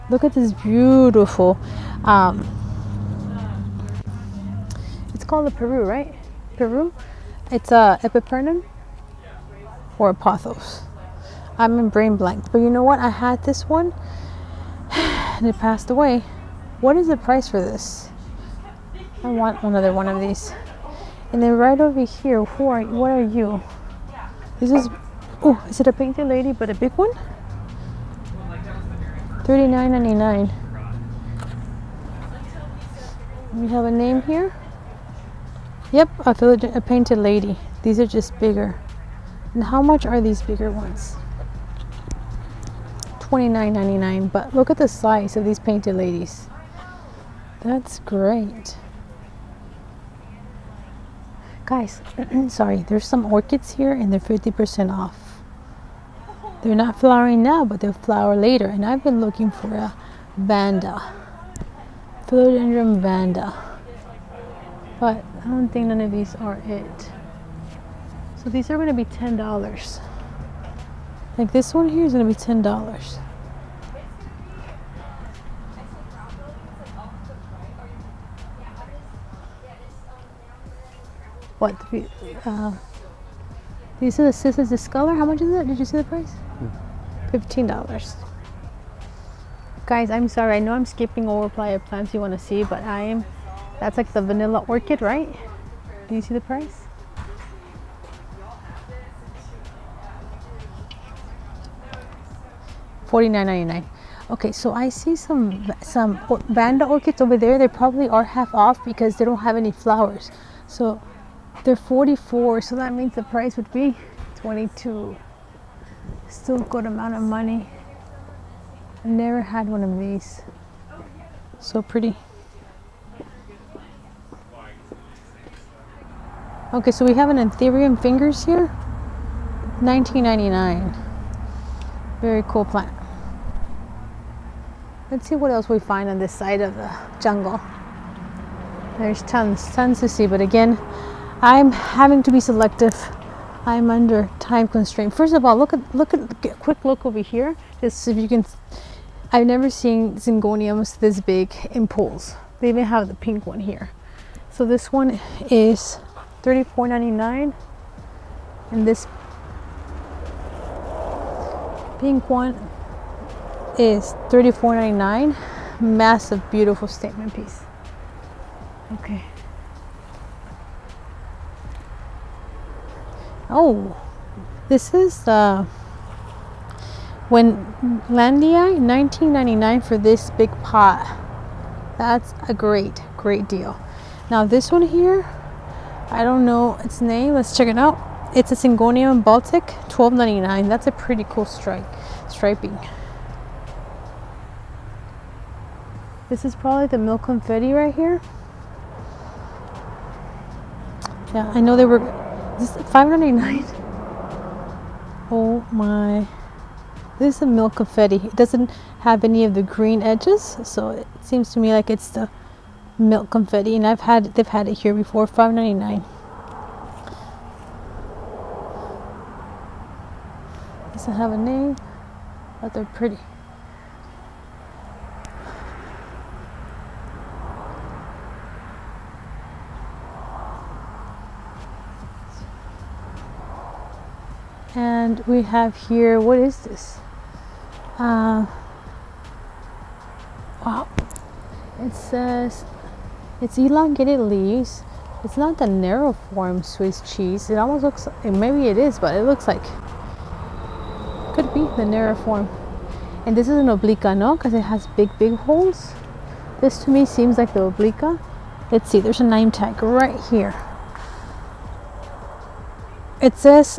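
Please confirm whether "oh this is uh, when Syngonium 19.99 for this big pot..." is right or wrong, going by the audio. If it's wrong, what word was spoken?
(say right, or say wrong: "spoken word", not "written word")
wrong: "Landia", not "Syngonium".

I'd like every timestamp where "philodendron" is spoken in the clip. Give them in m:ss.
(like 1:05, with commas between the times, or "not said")
1:02.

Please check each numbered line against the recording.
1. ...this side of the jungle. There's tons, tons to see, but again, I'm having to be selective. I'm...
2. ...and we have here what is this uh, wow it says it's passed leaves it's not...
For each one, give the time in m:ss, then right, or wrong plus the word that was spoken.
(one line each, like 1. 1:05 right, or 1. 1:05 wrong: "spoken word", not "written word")
1. 2:16 right
2. 3:54 wrong: "elongated", not "passed".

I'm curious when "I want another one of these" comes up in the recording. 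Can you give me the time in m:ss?
0:19.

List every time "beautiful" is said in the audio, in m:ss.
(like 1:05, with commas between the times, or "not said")
0:00, 2:46.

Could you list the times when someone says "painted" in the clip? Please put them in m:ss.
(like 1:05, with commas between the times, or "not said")
0:25, 0:36, 0:45.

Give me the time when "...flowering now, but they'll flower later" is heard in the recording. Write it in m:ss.
0:56.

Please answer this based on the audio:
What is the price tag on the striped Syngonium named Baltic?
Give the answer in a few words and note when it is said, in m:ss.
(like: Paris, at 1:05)
$12.99, at 3:09.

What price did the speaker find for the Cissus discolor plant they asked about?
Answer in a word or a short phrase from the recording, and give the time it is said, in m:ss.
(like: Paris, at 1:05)
$15, at 1:27.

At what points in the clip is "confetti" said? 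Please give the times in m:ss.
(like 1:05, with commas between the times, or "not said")
3:17, 3:27, 3:33.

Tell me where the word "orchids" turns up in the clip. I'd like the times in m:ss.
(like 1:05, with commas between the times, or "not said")
0:53, 1:34, 1:46.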